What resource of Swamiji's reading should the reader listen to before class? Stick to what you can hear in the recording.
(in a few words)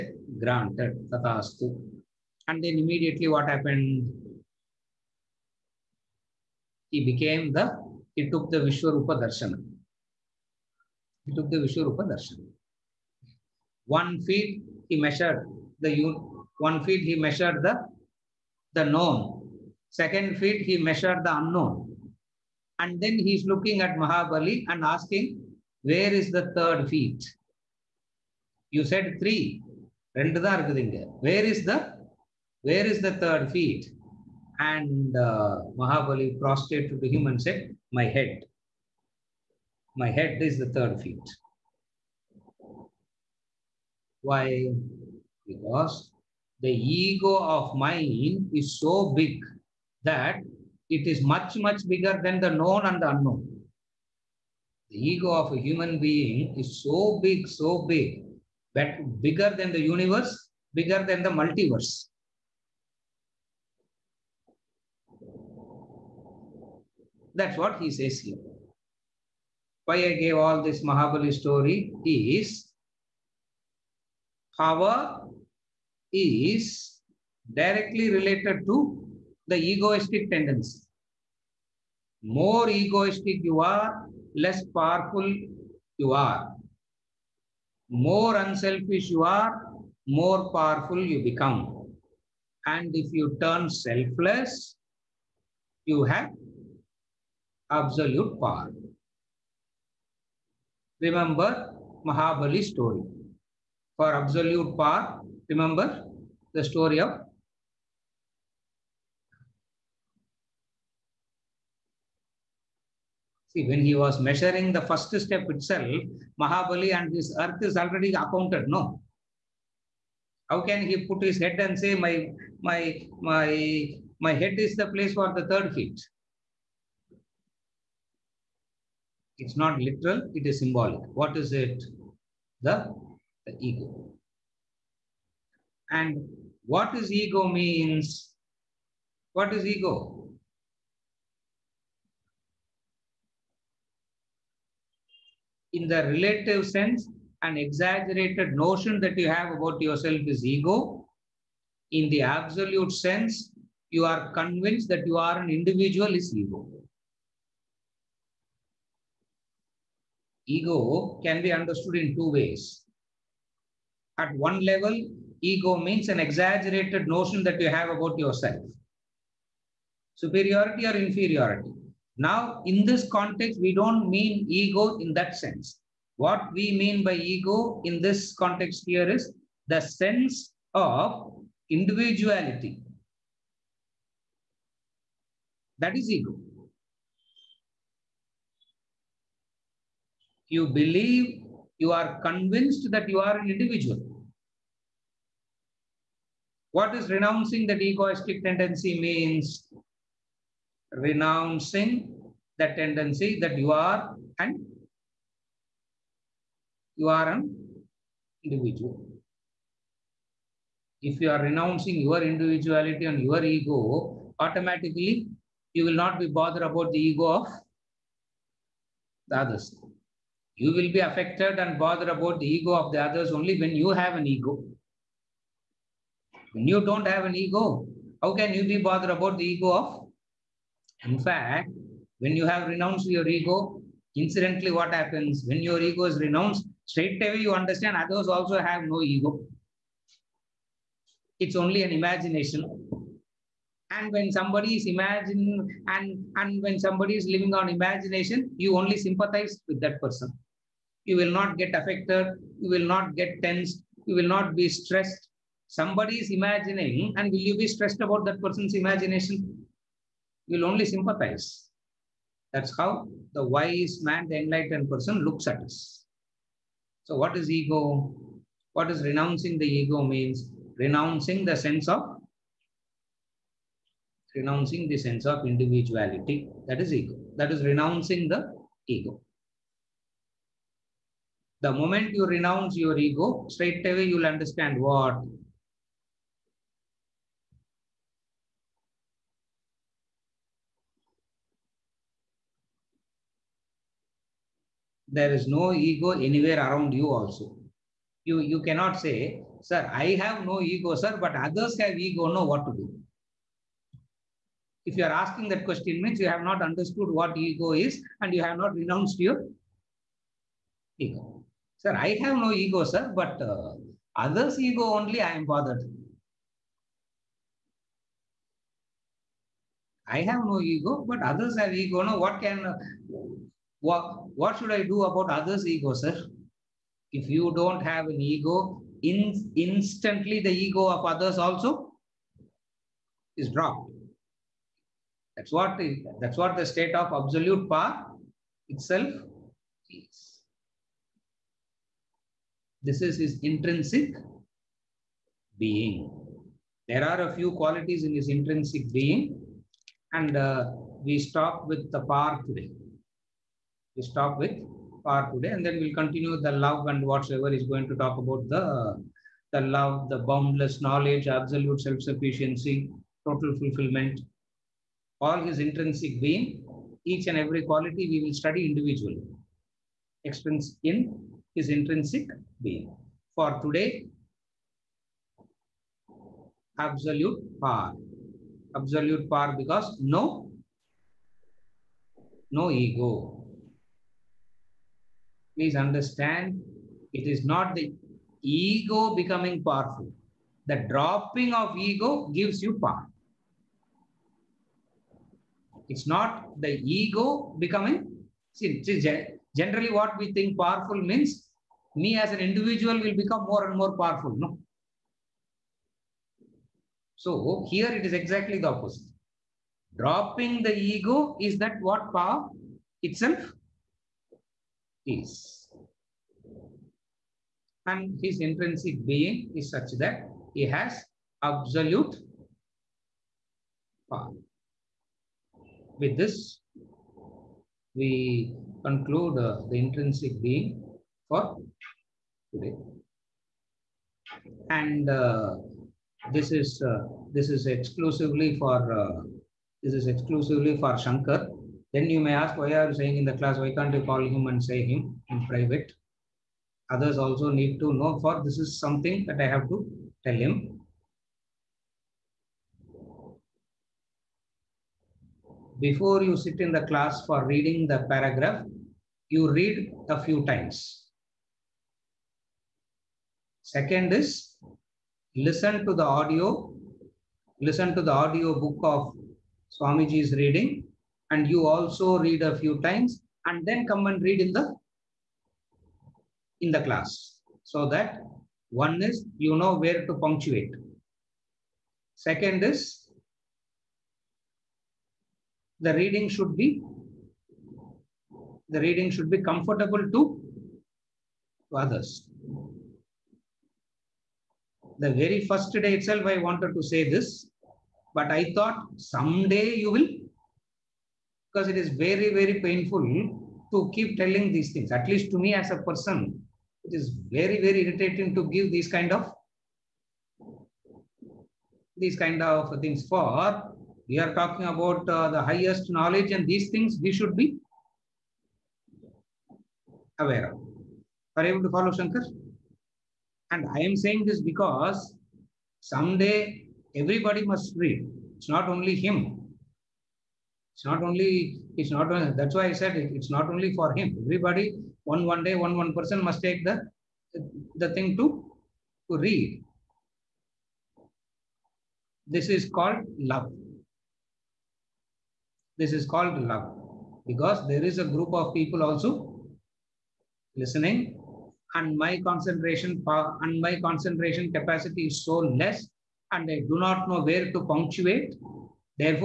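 audio book.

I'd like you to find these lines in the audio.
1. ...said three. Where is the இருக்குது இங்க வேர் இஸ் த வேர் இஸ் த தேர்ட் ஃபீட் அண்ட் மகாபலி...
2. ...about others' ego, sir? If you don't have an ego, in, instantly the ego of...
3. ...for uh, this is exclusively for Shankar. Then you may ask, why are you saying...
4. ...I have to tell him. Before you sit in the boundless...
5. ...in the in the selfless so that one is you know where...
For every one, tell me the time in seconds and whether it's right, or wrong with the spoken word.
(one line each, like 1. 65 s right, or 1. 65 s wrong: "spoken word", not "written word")
1. 28 s right
2. 325 s right
3. 438 s right
4. 449 s wrong: "class", not "boundless"
5. 474 s wrong: "class", not "selfless".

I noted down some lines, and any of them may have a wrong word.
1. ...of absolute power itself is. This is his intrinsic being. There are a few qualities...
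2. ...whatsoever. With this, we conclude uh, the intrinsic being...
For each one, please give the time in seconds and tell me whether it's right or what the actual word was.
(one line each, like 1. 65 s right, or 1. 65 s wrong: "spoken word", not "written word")
1. 336 s right
2. 424 s wrong: "power", not "whatsoever".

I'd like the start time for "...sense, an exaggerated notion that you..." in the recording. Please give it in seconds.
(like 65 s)
146 s.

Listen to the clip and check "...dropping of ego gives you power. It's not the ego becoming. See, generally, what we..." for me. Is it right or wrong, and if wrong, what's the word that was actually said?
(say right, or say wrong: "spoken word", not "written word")
right.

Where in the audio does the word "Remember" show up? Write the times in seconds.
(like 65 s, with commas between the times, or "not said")
100 s, 105 s.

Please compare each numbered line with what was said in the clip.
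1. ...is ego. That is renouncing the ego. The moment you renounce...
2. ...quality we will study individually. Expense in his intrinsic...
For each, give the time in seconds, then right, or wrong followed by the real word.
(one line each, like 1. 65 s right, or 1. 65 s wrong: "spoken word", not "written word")
1. 276 s right
2. 367 s right.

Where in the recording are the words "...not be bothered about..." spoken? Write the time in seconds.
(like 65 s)
215 s.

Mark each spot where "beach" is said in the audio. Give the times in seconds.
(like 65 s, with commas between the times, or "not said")
not said.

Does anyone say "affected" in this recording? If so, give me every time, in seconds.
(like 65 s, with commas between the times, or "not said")
220 s, 251 s.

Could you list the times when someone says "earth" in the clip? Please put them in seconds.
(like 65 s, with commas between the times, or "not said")
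117 s.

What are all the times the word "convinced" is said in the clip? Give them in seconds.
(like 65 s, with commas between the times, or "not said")
154 s, 192 s.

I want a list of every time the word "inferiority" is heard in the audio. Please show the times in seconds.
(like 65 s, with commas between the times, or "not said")
171 s.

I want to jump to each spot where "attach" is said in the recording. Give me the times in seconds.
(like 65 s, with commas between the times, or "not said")
not said.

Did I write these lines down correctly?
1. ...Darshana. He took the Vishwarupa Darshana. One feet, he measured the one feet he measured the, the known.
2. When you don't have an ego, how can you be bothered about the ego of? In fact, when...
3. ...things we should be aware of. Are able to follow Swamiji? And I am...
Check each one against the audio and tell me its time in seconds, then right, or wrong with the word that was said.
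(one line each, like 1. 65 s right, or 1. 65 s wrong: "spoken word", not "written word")
1. 9 s right
2. 226 s right
3. 516 s wrong: "Shankar", not "Swamiji".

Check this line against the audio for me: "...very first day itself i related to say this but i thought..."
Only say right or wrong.
wrong.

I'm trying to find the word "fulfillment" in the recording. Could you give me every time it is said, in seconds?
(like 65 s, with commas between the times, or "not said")
363 s.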